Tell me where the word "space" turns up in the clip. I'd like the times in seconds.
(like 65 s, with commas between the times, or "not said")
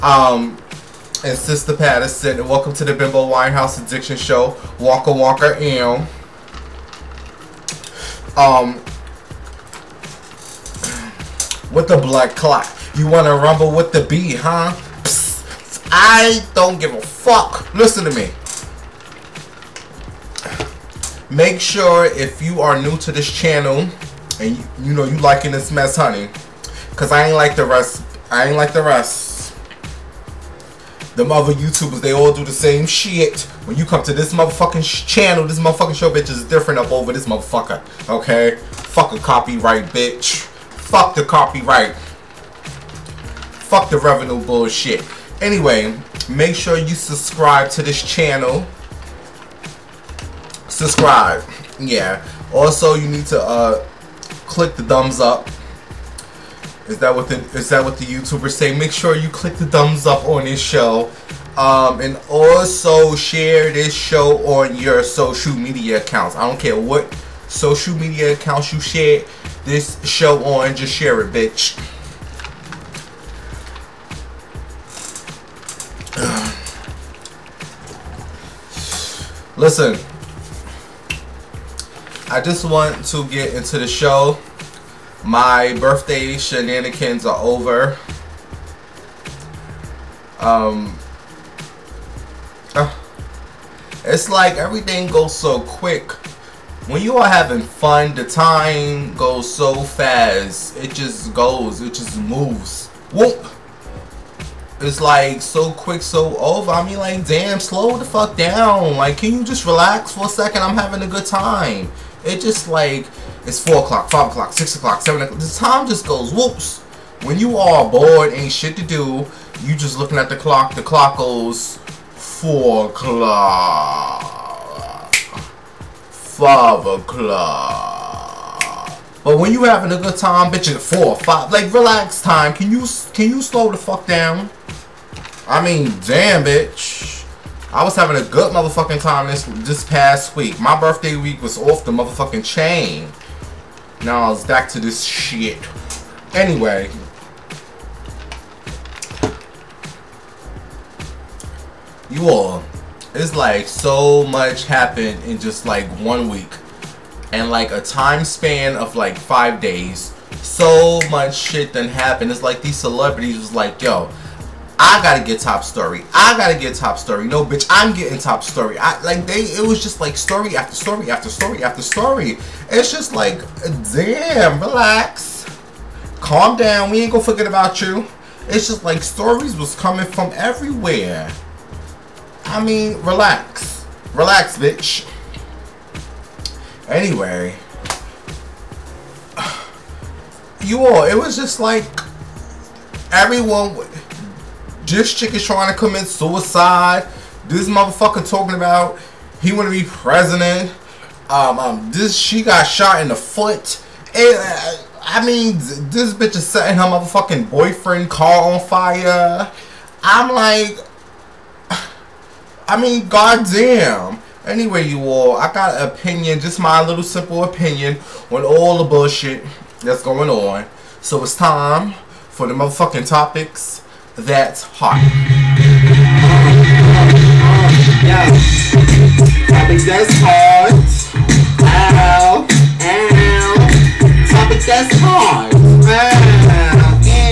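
not said.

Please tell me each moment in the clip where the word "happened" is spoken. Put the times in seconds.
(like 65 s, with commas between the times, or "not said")
154 s, 161 s.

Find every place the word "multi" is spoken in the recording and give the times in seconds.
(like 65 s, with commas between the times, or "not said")
not said.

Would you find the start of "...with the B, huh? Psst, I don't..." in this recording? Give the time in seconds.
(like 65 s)
13 s.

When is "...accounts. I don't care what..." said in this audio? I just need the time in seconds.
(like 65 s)
66 s.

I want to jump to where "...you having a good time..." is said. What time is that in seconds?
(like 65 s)
129 s.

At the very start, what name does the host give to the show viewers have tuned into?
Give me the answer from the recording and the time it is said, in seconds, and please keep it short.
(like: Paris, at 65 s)
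Bimbo Winehouse Addiction Show, at 2 s.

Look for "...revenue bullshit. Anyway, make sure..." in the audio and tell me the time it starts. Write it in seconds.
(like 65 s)
43 s.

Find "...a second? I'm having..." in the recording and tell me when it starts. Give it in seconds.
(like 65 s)
110 s.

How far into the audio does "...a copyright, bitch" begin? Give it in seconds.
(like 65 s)
39 s.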